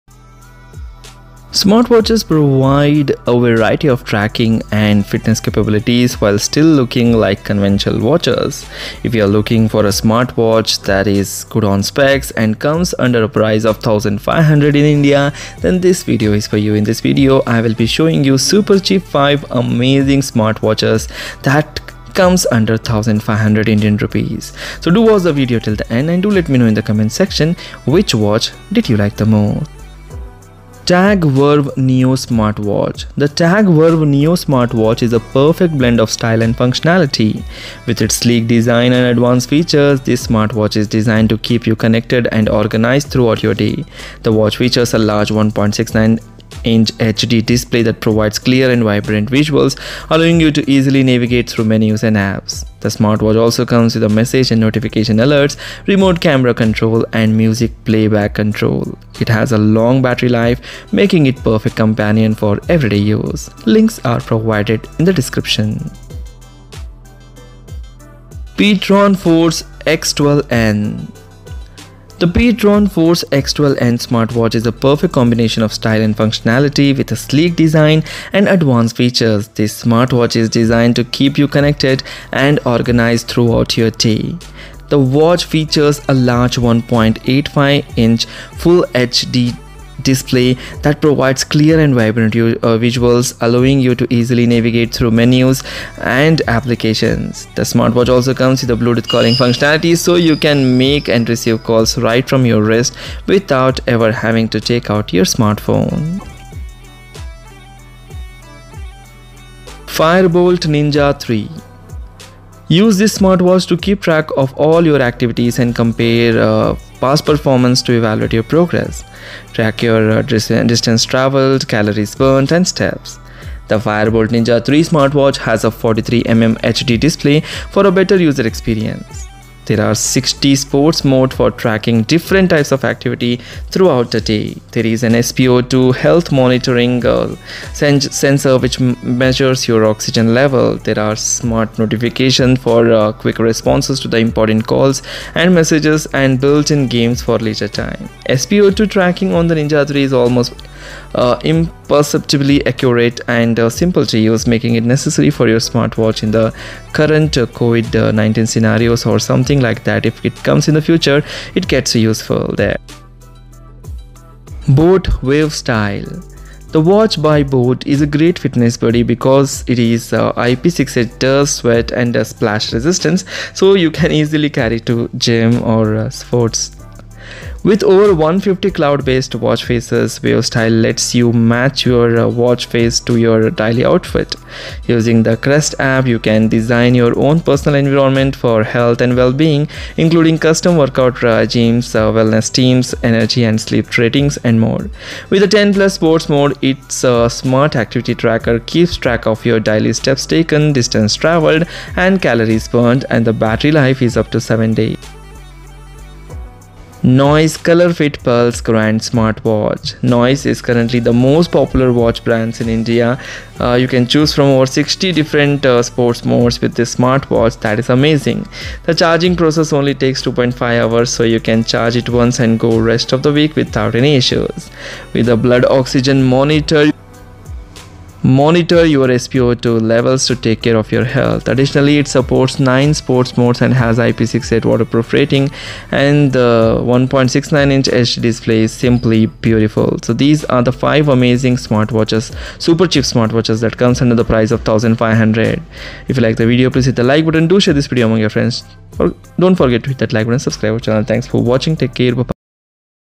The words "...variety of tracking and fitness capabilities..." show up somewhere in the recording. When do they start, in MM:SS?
00:03.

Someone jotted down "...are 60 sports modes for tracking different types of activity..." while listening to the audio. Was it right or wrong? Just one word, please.
right.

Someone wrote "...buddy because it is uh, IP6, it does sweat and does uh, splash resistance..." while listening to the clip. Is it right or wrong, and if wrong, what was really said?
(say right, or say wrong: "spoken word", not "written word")
right.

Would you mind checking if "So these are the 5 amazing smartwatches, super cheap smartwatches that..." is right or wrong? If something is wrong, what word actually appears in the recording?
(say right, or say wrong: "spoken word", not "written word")
right.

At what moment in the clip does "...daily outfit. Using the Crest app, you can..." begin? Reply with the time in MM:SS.
03:03.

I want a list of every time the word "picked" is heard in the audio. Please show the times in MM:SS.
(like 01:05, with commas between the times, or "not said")
not said.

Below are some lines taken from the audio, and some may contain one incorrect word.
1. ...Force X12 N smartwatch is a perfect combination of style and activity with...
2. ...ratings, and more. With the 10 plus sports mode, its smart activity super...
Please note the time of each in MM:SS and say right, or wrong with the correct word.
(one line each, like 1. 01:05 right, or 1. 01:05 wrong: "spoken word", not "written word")
1. 01:12 wrong: "functionality", not "activity"
2. 03:13 wrong: "tracker", not "super".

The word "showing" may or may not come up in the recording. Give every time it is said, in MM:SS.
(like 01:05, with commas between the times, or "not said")
00:17.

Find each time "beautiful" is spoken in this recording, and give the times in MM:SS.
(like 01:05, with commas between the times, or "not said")
03:59.